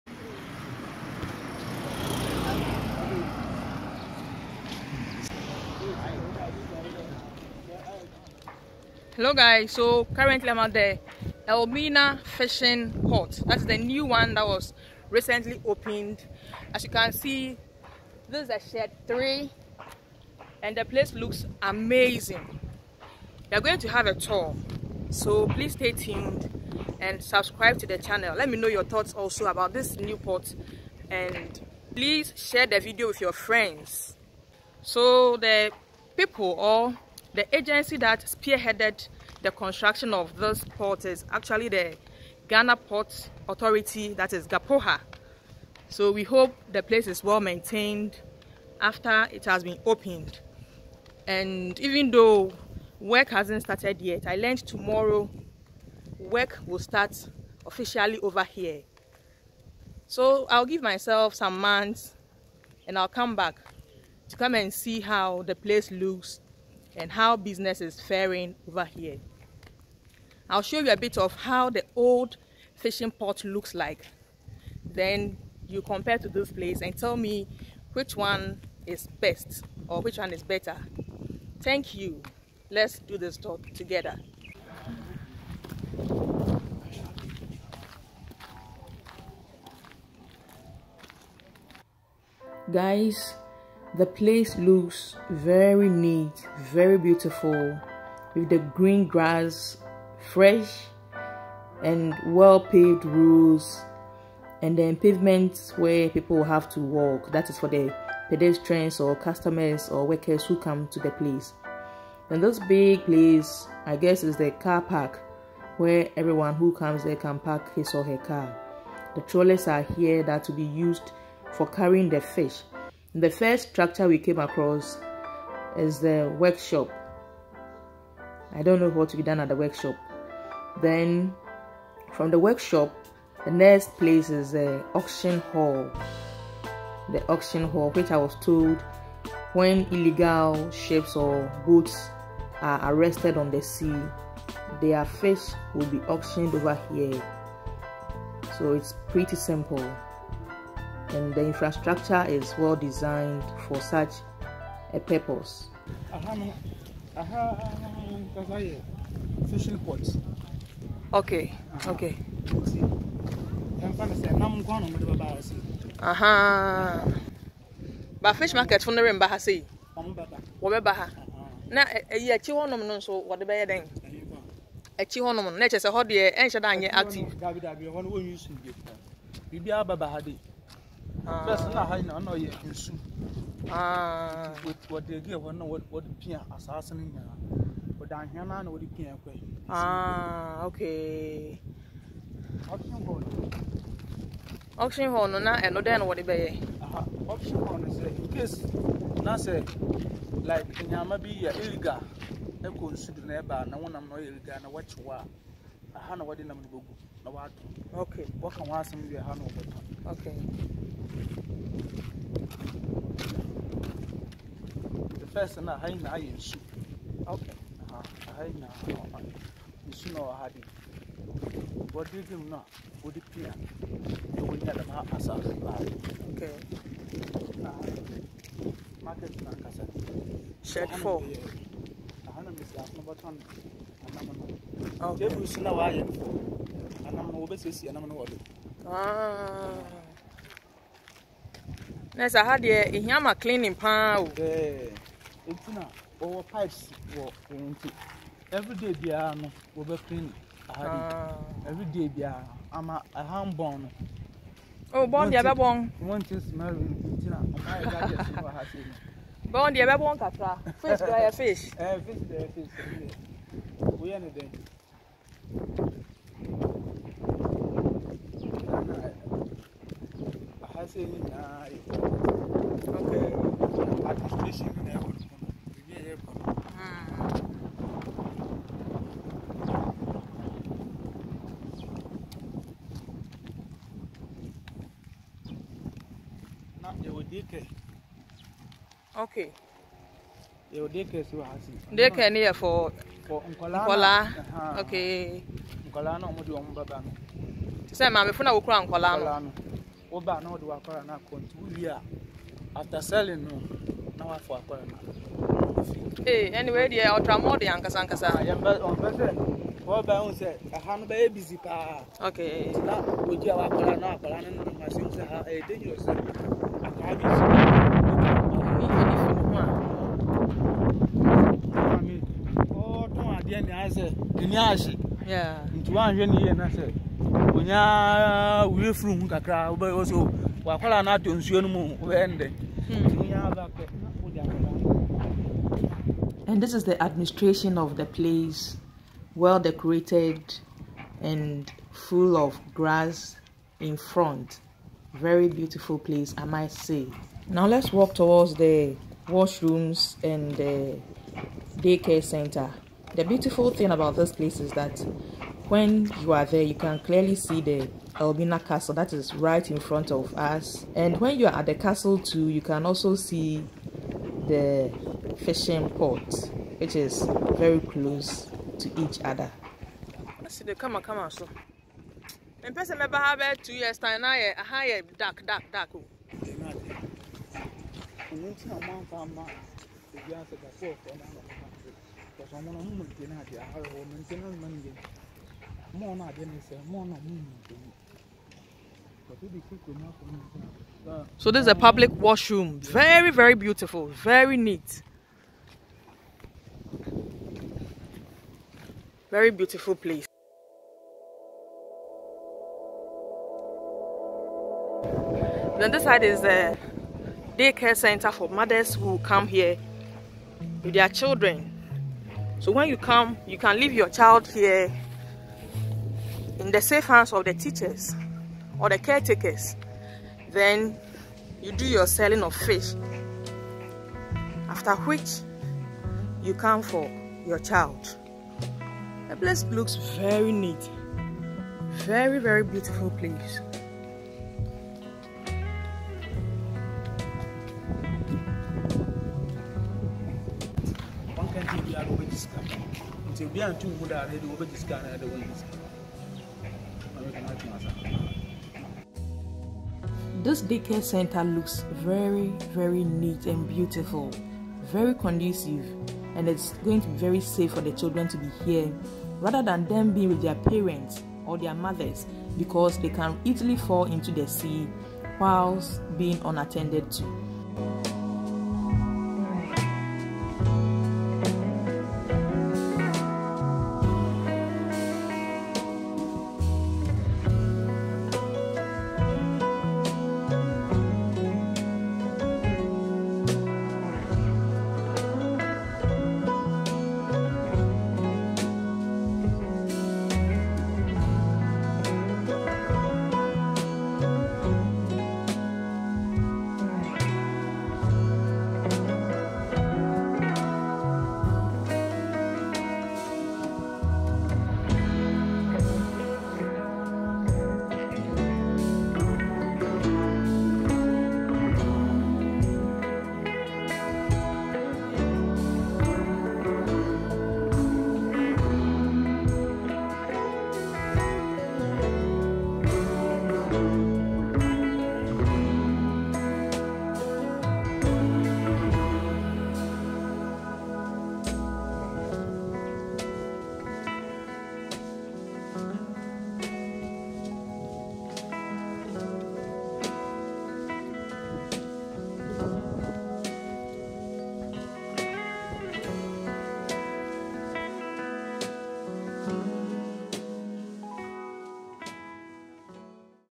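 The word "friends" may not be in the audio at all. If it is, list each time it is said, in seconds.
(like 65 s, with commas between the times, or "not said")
33 s.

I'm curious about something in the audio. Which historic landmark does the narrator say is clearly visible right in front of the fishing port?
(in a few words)
Elmina Castle.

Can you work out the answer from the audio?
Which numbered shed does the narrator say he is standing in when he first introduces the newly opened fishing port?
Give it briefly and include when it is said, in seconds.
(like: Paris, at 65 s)
Shed 3, at 18 s.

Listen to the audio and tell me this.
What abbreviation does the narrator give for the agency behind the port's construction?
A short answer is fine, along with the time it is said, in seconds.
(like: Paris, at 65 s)
GHAPOHA, at 44 s.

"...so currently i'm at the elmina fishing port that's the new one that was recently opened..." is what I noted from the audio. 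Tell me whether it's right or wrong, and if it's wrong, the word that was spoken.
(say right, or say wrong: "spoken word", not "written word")
right.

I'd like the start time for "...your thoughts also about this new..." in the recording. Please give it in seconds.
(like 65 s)
28 s.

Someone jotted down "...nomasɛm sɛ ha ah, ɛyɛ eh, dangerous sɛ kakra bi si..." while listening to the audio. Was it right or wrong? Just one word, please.
wrong.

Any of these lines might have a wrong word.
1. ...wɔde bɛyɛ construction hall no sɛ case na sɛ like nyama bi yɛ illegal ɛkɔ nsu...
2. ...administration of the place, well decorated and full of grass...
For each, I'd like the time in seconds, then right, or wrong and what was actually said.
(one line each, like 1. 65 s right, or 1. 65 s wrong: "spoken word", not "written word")
1. 196 s wrong: "auction", not "construction"
2. 337 s right.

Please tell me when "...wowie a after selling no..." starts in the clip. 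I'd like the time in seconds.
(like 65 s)
301 s.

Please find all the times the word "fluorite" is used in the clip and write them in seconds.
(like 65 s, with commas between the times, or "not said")
not said.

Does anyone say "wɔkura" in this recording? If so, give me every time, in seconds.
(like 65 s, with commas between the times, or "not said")
298 s.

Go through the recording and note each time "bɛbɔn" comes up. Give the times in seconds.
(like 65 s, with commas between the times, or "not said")
255 s, 259 s.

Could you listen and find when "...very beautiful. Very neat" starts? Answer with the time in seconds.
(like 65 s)
393 s.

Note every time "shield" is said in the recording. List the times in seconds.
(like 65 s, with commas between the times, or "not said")
not said.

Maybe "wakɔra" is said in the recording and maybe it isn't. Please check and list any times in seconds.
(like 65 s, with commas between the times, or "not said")
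300 s, 313 s.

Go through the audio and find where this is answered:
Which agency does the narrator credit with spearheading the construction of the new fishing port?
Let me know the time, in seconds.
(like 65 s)
42 s.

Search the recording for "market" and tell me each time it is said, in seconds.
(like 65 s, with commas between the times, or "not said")
168 s, 229 s.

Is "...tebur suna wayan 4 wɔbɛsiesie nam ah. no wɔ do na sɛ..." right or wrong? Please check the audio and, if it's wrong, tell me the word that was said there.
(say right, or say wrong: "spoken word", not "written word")
right.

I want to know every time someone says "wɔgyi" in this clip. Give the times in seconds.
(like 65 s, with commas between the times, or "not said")
313 s.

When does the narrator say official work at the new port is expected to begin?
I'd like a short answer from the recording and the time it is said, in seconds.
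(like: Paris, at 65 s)
Tomorrow, at 54 s.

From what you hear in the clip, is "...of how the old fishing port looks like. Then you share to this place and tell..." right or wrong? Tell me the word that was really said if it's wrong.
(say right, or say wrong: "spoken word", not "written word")
wrong: "compare", not "share".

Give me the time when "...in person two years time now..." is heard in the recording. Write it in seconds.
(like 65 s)
372 s.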